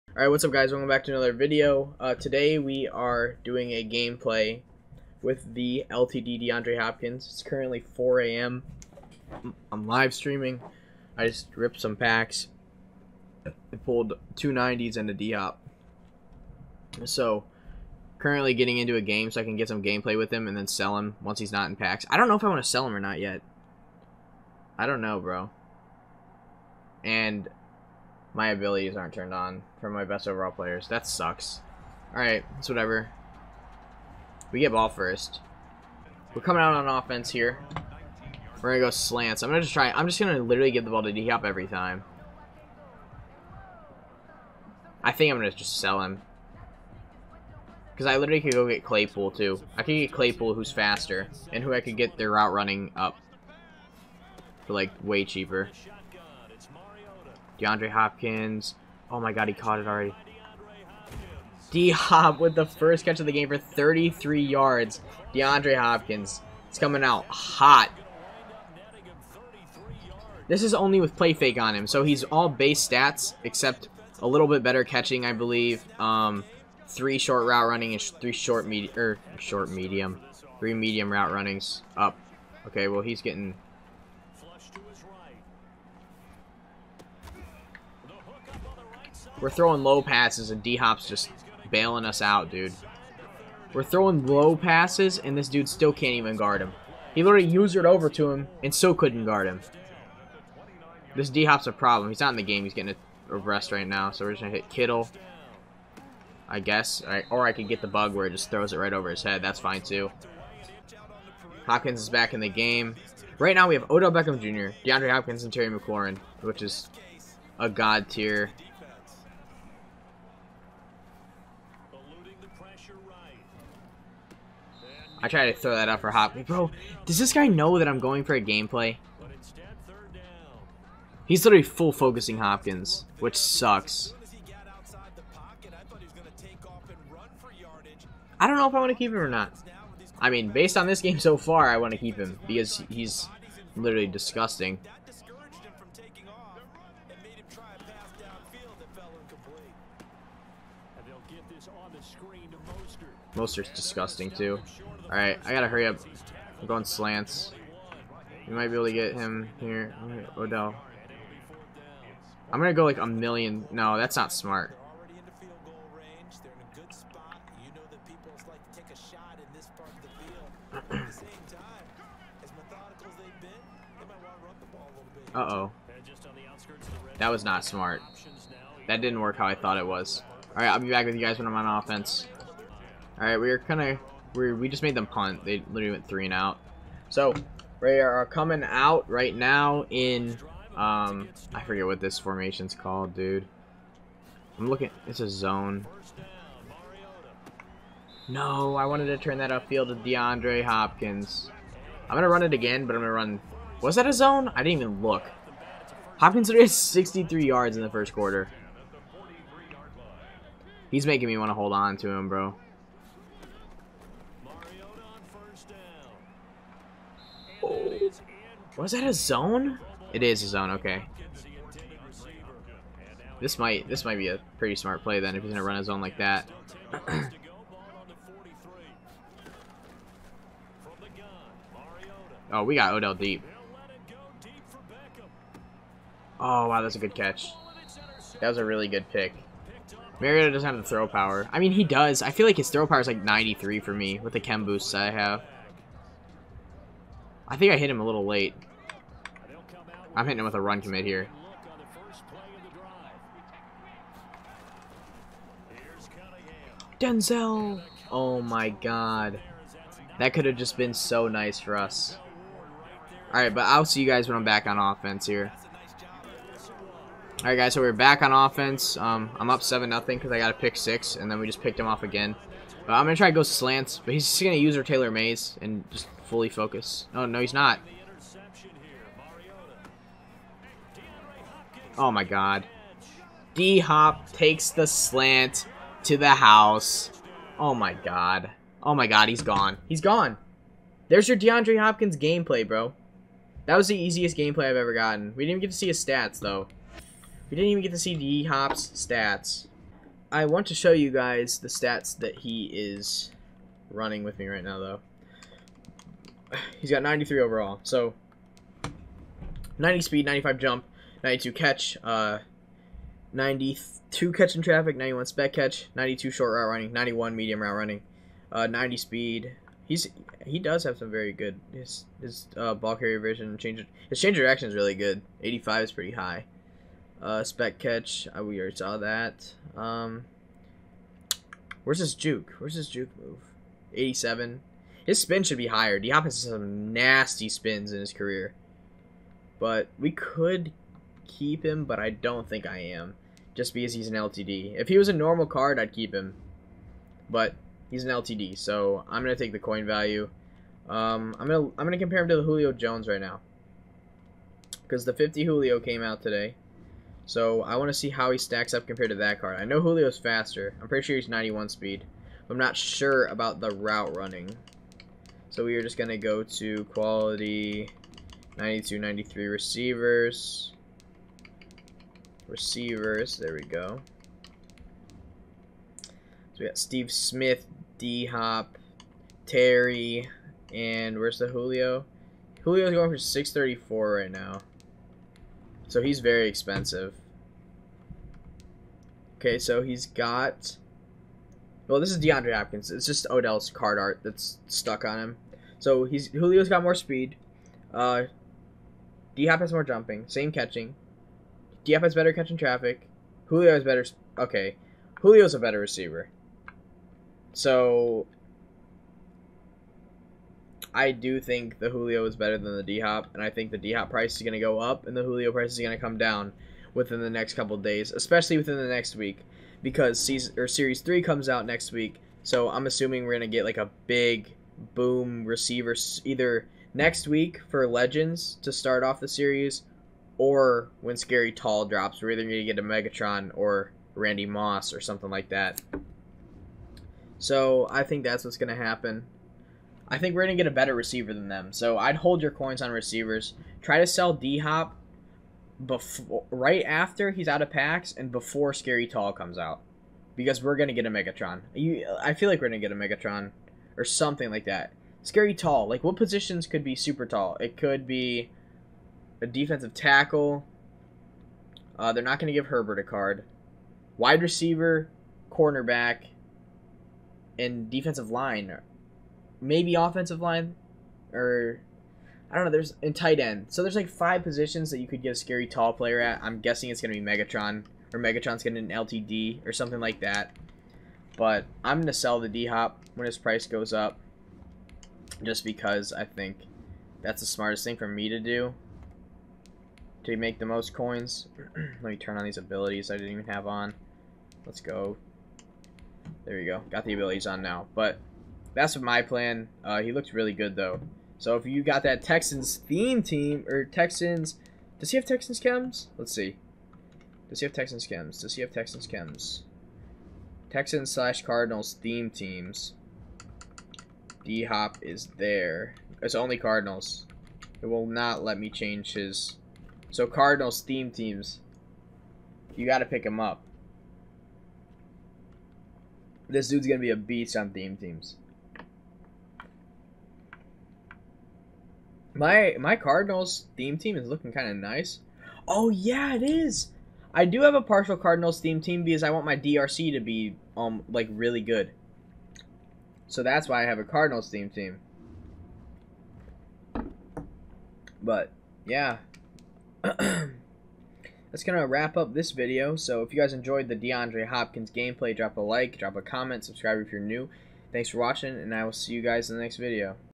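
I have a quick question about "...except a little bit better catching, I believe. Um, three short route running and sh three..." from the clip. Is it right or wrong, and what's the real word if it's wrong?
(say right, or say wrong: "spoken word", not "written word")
right.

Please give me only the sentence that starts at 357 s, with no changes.
So I want to see how he stacks up compared to that card.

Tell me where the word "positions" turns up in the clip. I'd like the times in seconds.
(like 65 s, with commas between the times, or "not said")
456 s, 474 s.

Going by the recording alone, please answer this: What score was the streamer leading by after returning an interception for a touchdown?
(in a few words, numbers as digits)
7 nothing.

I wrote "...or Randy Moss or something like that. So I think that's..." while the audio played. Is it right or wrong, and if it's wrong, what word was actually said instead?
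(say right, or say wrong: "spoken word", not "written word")
right.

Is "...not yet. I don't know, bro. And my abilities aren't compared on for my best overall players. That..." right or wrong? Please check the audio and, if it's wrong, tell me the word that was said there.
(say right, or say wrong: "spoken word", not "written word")
wrong: "turned", not "compared".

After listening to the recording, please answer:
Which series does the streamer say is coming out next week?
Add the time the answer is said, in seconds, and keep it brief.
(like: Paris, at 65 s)
series three, at 420 s.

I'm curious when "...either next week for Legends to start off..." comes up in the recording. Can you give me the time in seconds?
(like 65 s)
426 s.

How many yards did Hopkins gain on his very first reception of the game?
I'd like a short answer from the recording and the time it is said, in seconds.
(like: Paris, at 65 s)
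33, at 63 s.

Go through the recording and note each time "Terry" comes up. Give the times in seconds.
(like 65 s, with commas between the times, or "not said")
115 s, 379 s.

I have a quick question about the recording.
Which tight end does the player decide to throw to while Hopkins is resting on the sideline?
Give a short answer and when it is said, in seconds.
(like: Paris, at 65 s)
Kittle, at 104 s.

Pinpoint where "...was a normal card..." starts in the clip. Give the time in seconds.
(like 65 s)
344 s.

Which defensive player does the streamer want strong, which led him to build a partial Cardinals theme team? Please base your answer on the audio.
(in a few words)
DRC.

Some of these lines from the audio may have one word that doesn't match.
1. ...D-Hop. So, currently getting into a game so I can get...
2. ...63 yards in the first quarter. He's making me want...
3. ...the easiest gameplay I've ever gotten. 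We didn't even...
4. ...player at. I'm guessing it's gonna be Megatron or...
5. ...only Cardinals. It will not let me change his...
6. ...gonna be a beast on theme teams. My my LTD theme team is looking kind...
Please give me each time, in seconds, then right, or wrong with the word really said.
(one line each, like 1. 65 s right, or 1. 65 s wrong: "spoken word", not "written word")
1. 15 s right
2. 206 s right
3. 293 s right
4. 475 s right
5. 516 s right
6. 526 s wrong: "Cardinals", not "LTD".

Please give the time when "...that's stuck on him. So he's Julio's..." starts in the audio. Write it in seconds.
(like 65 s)
394 s.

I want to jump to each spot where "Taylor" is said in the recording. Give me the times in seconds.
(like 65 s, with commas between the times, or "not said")
274 s.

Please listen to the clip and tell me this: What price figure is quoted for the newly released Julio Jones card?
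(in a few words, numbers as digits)
634.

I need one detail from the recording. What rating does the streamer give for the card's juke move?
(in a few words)
87.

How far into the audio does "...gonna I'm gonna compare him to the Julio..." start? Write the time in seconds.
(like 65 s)
351 s.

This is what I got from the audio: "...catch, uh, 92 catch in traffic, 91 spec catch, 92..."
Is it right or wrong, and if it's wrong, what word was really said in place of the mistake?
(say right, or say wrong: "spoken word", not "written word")
right.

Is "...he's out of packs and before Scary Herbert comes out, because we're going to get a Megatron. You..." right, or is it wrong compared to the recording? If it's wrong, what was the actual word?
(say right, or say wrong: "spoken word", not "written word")
wrong: "Tall", not "Herbert".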